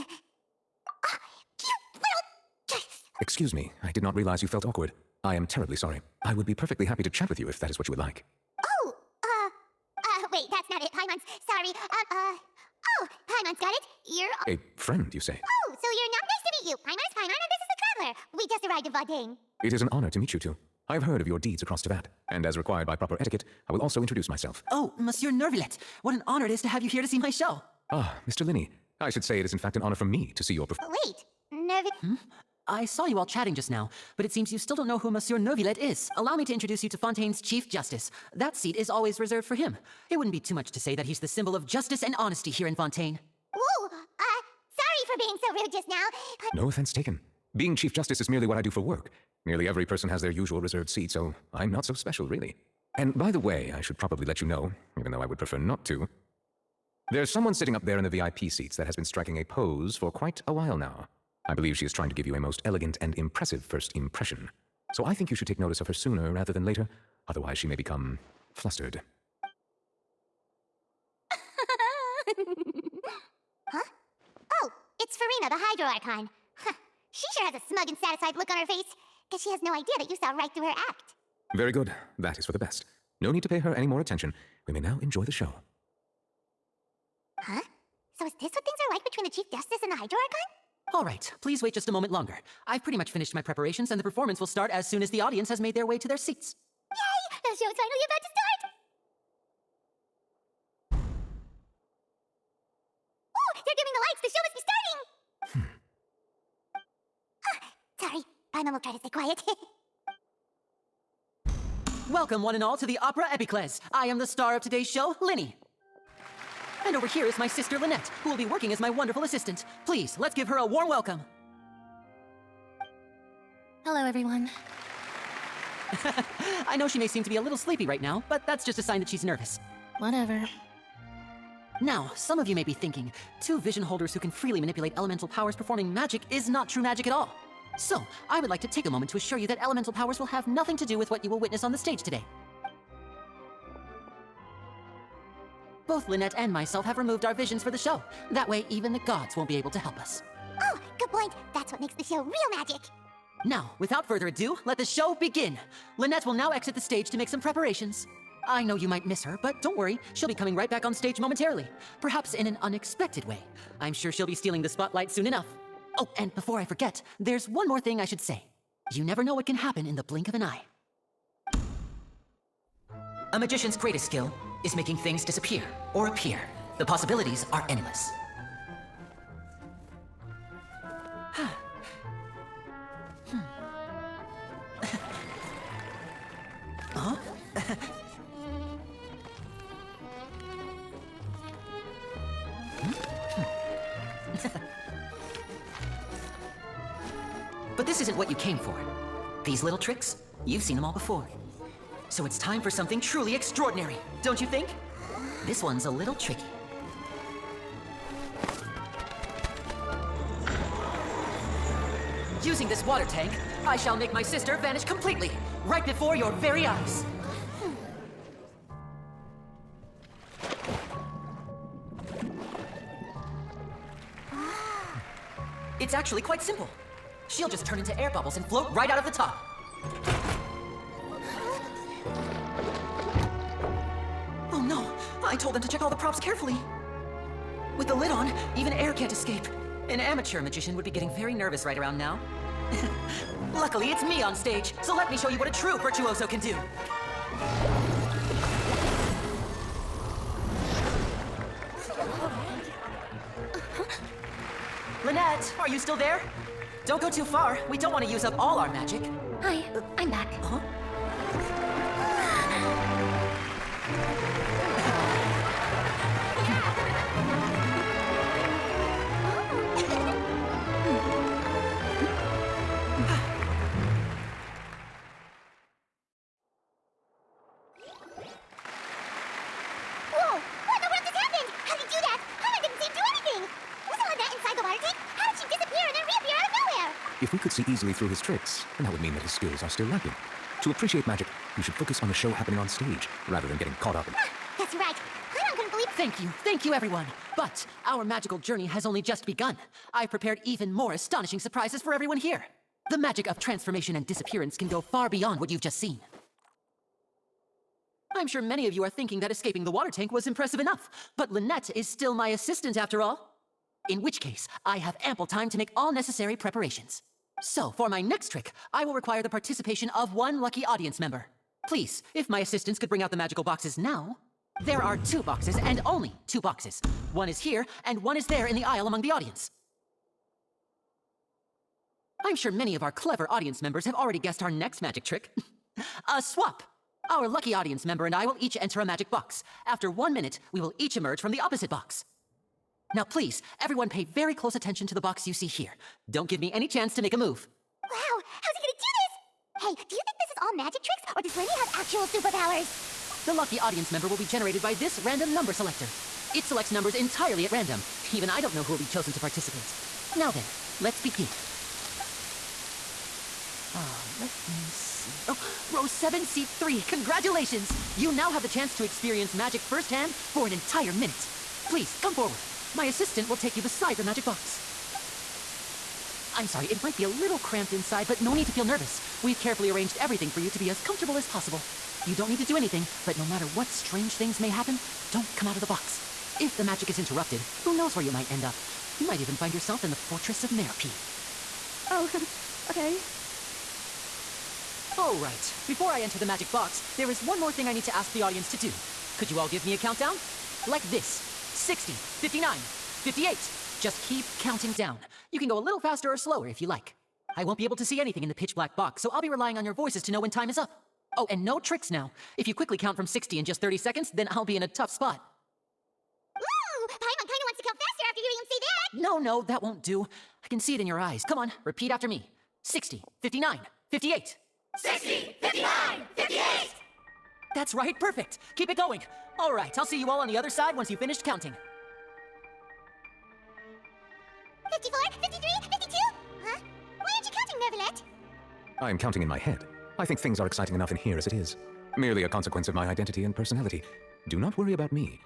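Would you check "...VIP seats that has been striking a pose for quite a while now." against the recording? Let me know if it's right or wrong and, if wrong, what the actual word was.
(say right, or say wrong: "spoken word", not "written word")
right.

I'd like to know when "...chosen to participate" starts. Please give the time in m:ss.
5:58.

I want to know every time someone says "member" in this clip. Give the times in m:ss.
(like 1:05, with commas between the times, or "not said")
5:20, 5:33, 5:37, 5:53.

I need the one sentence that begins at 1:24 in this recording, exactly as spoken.
We may now enjoy the show.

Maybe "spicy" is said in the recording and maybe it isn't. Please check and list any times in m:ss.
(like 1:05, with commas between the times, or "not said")
not said.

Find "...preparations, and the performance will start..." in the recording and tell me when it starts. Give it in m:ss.
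1:33.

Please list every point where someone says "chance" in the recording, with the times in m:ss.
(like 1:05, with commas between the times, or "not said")
5:46, 6:08.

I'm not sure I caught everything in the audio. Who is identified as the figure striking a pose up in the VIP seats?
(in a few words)
Furina.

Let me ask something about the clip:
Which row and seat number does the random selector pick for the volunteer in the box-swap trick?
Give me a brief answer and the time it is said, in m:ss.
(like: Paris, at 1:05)
row 7, seat 3, at 6:05.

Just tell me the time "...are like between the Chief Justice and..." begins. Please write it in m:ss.
1:28.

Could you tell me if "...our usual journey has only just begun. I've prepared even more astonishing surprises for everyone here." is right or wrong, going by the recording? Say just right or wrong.
wrong.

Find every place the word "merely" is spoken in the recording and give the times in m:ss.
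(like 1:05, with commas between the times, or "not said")
0:48, 7:21.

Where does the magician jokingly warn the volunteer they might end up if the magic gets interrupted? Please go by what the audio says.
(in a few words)
Fortress of Meropide.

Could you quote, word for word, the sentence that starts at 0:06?
I would be perfectly happy to chat with you if that is what you would like.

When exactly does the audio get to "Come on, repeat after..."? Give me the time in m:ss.
7:01.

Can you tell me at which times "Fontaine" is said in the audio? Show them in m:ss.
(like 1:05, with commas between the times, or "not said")
0:36, 0:42.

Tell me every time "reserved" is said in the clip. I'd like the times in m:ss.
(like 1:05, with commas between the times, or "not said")
0:39, 0:50.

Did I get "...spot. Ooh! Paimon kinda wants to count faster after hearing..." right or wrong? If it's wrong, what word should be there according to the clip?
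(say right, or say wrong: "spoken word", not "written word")
right.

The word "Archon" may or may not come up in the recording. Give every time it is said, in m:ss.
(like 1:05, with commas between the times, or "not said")
1:15, 1:30.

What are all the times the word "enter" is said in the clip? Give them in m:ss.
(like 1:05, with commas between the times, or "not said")
5:38, 6:35.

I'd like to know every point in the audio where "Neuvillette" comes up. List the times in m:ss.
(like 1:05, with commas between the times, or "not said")
0:25, 0:35.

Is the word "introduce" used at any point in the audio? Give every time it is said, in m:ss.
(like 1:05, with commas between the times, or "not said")
0:24, 0:36.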